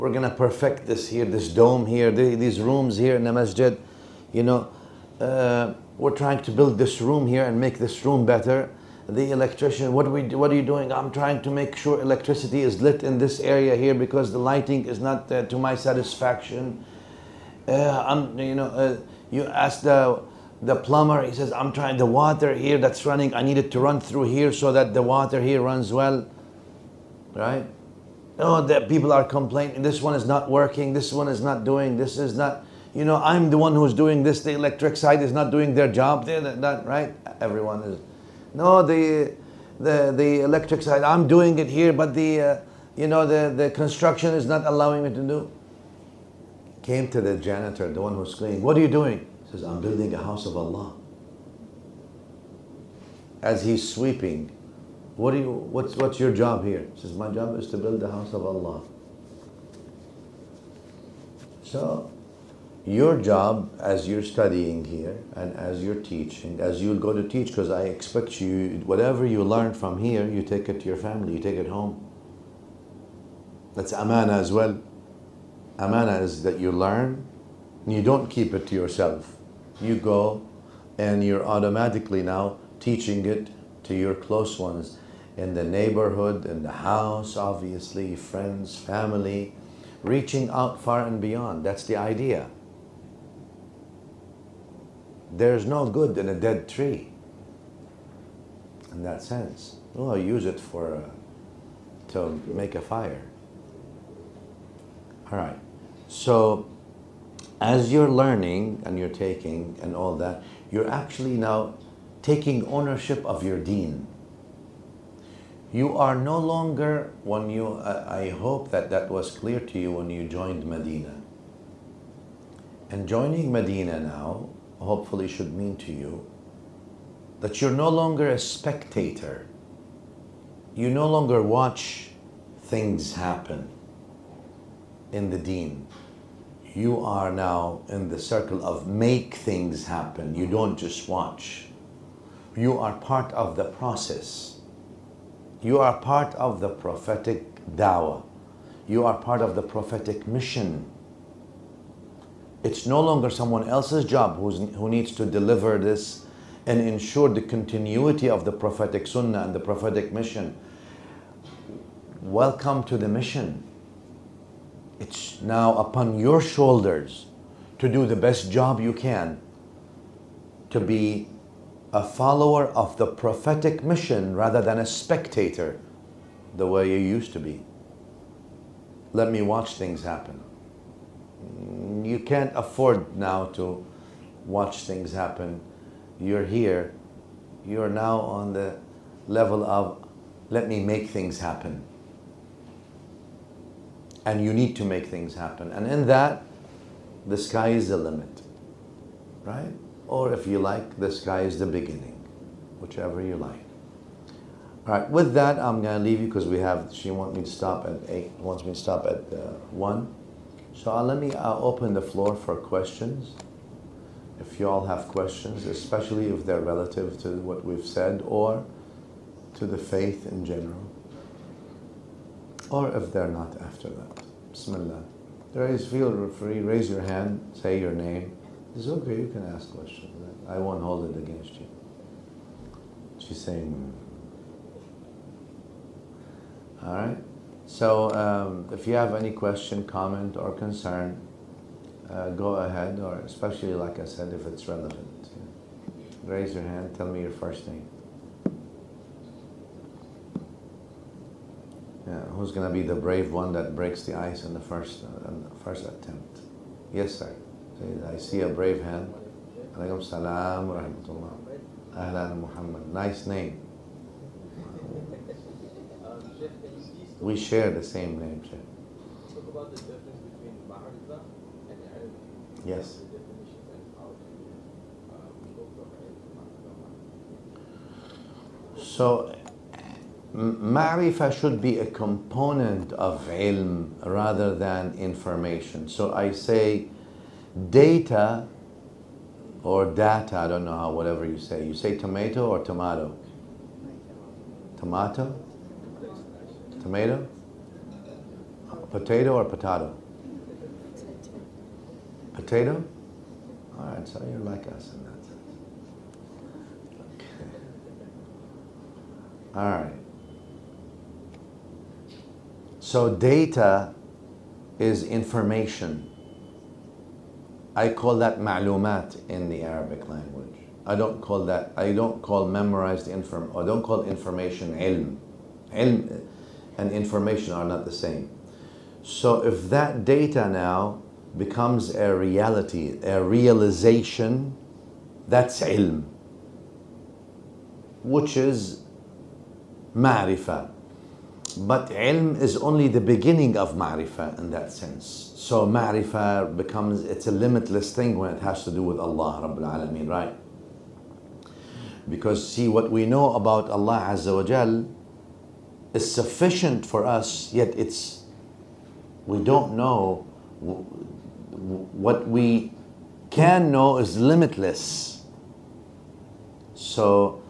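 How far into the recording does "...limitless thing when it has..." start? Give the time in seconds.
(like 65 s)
347 s.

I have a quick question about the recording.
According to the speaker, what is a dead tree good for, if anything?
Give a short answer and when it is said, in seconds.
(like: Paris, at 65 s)
To make a fire, at 102 s.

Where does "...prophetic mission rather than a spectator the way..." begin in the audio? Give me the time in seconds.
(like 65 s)
173 s.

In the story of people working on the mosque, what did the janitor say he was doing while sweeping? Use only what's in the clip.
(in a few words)
Building a house of Allah.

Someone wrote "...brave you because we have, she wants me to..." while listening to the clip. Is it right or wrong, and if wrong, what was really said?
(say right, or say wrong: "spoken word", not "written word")
wrong: "leave", not "brave".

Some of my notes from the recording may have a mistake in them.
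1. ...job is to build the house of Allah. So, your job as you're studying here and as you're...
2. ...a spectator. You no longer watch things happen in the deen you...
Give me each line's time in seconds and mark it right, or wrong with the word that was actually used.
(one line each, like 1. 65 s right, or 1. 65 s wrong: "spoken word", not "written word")
1. 57 s right
2. 128 s right.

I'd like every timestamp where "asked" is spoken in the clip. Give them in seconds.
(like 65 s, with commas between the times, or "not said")
19 s.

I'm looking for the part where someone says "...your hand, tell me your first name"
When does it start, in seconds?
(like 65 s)
246 s.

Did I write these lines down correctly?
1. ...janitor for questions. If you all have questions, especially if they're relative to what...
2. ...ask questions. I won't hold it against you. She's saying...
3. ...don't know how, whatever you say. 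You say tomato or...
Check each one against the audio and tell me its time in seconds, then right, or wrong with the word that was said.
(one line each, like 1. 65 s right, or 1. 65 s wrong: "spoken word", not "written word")
1. 212 s wrong: "floor", not "janitor"
2. 229 s right
3. 290 s right.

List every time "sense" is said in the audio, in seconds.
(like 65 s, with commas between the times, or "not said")
99 s, 305 s, 344 s.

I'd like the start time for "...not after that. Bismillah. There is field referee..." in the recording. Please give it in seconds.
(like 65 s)
223 s.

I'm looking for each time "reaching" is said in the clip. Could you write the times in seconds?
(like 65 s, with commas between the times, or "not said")
90 s.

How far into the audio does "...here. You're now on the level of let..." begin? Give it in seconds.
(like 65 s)
186 s.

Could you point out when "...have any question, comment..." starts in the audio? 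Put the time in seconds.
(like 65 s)
238 s.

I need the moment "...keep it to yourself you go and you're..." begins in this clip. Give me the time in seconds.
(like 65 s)
78 s.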